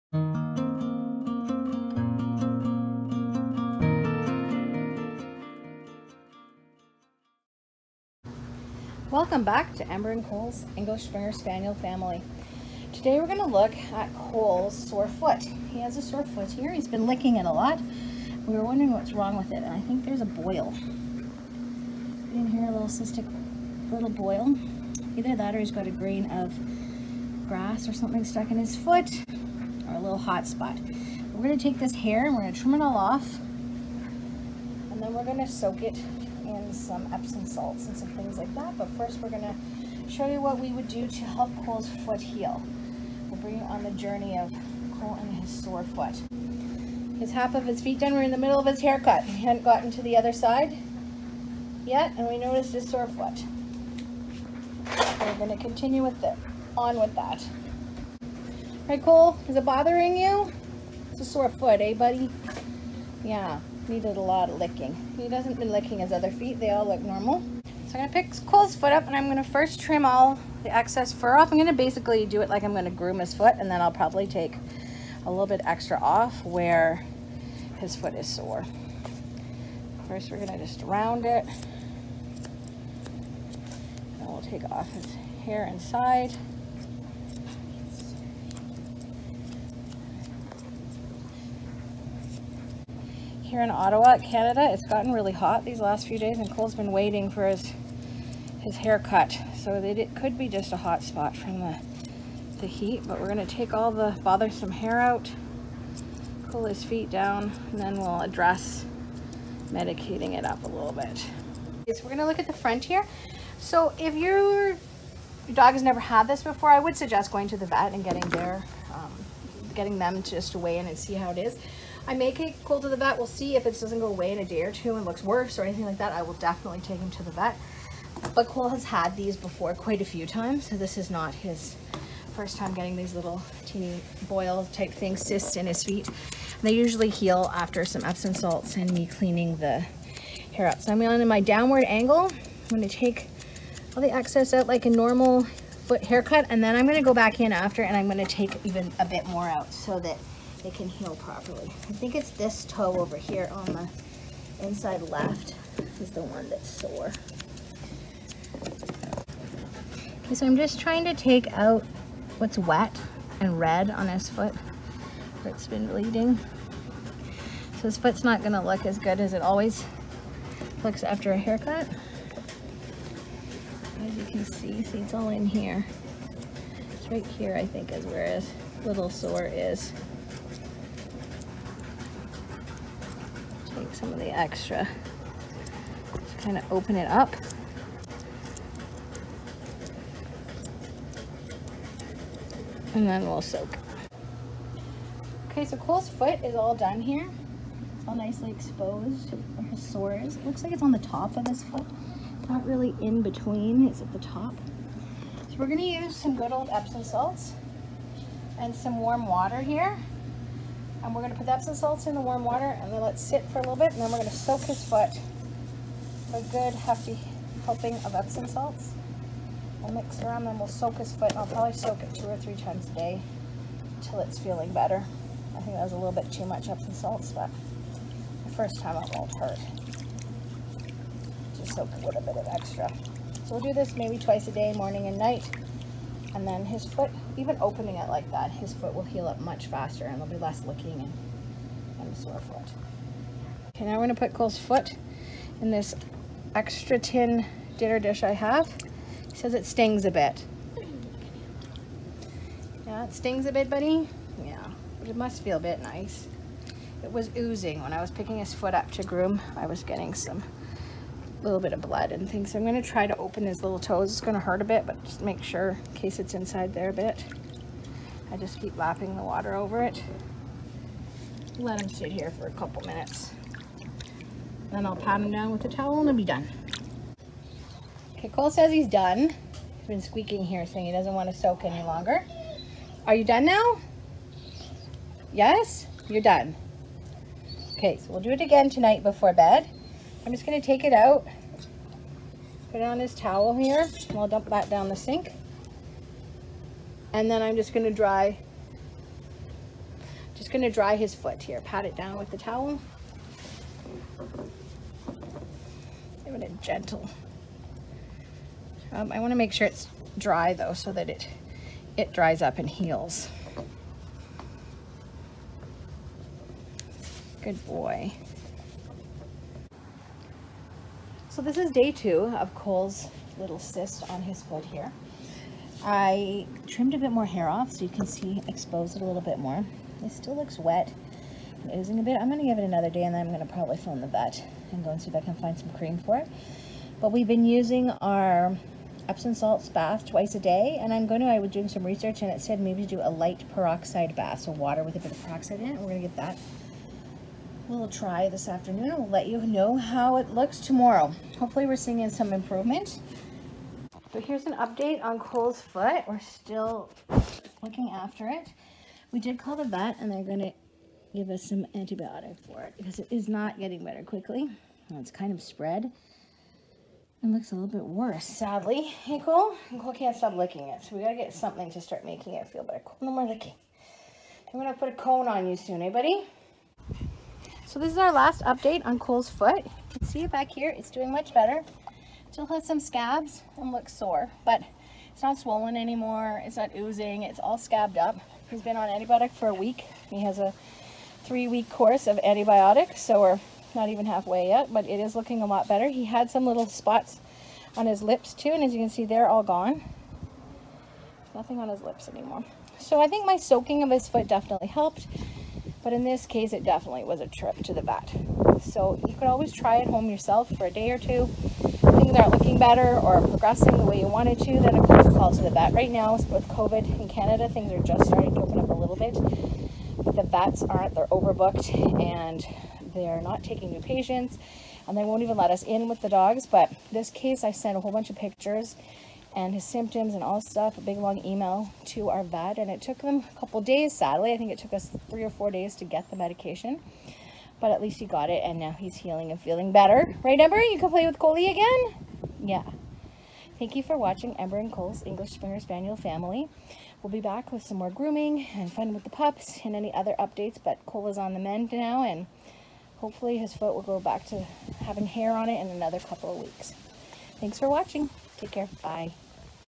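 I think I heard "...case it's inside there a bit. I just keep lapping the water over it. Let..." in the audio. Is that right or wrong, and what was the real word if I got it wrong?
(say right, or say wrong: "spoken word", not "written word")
right.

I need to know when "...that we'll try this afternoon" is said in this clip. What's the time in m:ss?
5:46.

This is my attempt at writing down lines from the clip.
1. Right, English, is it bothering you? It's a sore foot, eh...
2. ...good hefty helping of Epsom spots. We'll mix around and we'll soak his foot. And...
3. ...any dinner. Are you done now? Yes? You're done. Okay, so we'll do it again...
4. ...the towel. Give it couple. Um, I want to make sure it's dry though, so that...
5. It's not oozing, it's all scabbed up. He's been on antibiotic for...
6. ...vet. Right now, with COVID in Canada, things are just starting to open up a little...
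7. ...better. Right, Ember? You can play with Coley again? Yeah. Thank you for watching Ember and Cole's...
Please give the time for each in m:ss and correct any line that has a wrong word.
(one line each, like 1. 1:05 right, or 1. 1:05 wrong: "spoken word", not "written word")
1. 0:58 wrong: "Cole", not "English"
2. 3:36 wrong: "salts", not "spots"
3. 4:41 wrong: "longer", not "dinner"
4. 5:02 wrong: "gentle", not "couple"
5. 6:26 right
6. 6:55 right
7. 7:19 right.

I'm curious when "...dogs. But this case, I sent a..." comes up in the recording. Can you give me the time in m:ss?
7:06.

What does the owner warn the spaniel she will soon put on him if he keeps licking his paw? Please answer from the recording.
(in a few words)
a cone.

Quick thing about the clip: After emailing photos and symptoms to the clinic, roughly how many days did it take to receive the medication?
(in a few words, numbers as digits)
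3 or 4 days.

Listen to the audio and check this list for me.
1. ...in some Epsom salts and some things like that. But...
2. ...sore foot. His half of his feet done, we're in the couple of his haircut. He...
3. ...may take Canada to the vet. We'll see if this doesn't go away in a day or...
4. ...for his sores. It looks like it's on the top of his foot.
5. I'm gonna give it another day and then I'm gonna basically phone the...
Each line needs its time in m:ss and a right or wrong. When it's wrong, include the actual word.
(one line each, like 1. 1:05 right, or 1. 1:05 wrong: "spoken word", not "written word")
1. 0:36 right
2. 0:45 wrong: "middle", not "couple"
3. 2:02 wrong: "Cole", not "Canada"
4. 3:19 right
5. 5:32 wrong: "probably", not "basically".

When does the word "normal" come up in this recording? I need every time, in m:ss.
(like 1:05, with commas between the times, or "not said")
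1:07, 2:24.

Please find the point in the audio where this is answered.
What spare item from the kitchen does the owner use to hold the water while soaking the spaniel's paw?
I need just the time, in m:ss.
4:06.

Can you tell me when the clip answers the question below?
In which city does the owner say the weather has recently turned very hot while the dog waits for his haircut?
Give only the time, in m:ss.
1:33.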